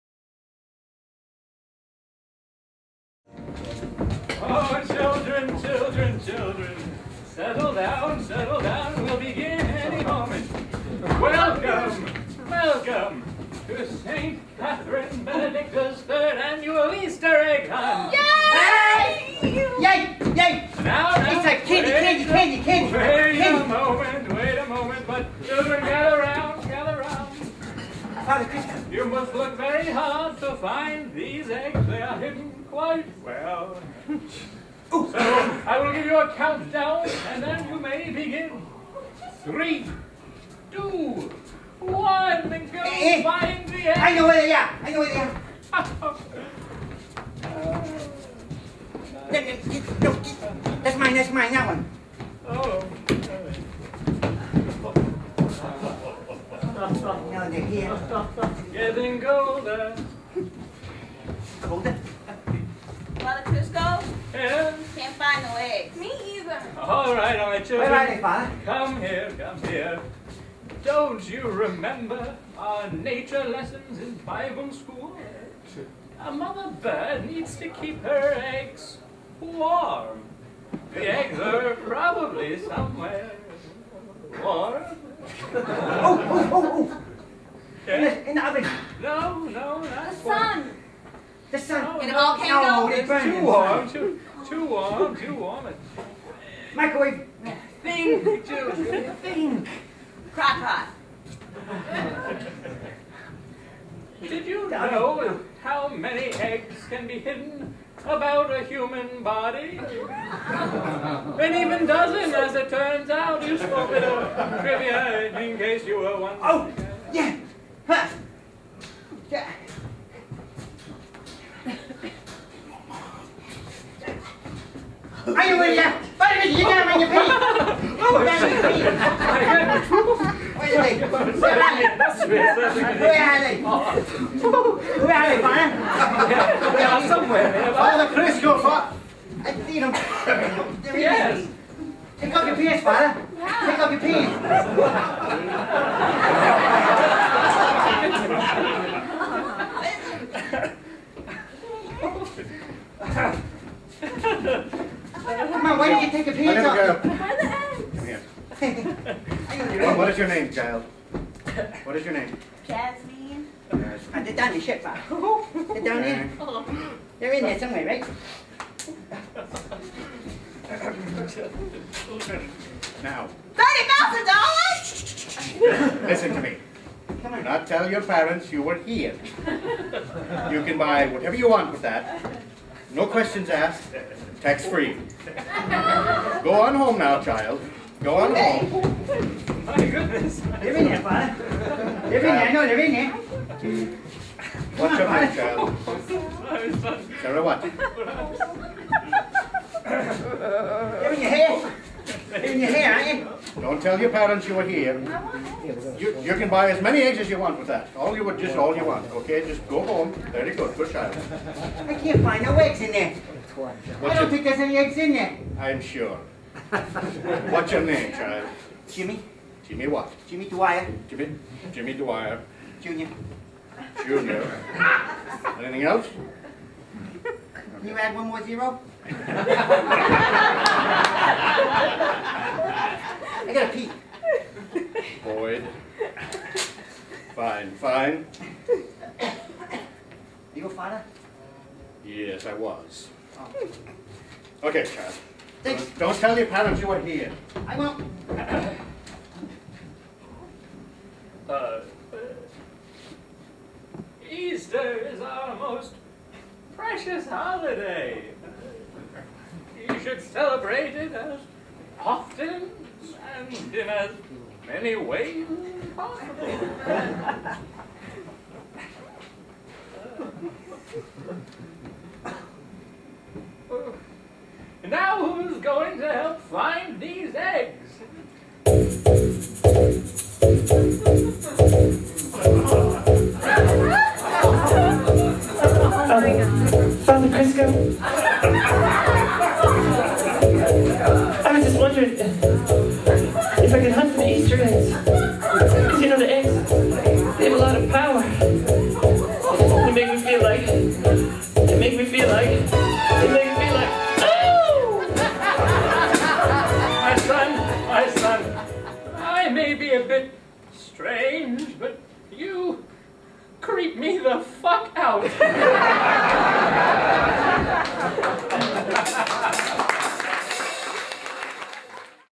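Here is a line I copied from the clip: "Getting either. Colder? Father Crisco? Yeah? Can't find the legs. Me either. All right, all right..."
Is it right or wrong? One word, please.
wrong.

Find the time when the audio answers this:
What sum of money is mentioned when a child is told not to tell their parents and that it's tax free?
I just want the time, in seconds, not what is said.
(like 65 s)
173 s.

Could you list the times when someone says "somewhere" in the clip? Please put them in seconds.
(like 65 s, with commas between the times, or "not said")
82 s, 167 s.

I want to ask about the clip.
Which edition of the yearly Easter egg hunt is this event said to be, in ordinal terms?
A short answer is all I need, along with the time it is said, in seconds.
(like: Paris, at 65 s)
third, at 16 s.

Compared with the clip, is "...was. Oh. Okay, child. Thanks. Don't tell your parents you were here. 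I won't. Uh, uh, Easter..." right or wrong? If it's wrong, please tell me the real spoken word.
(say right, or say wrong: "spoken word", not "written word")
right.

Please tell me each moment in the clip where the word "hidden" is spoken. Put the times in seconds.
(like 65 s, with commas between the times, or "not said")
32 s, 107 s.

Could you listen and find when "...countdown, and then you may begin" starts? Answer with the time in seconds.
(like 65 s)
36 s.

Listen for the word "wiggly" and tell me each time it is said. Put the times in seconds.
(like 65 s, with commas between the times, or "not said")
not said.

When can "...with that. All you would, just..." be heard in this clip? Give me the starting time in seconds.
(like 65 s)
207 s.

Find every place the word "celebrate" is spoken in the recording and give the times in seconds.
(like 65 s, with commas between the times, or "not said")
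260 s.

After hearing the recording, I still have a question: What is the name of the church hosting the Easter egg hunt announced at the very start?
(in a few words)
St. Catherine Benedicta's.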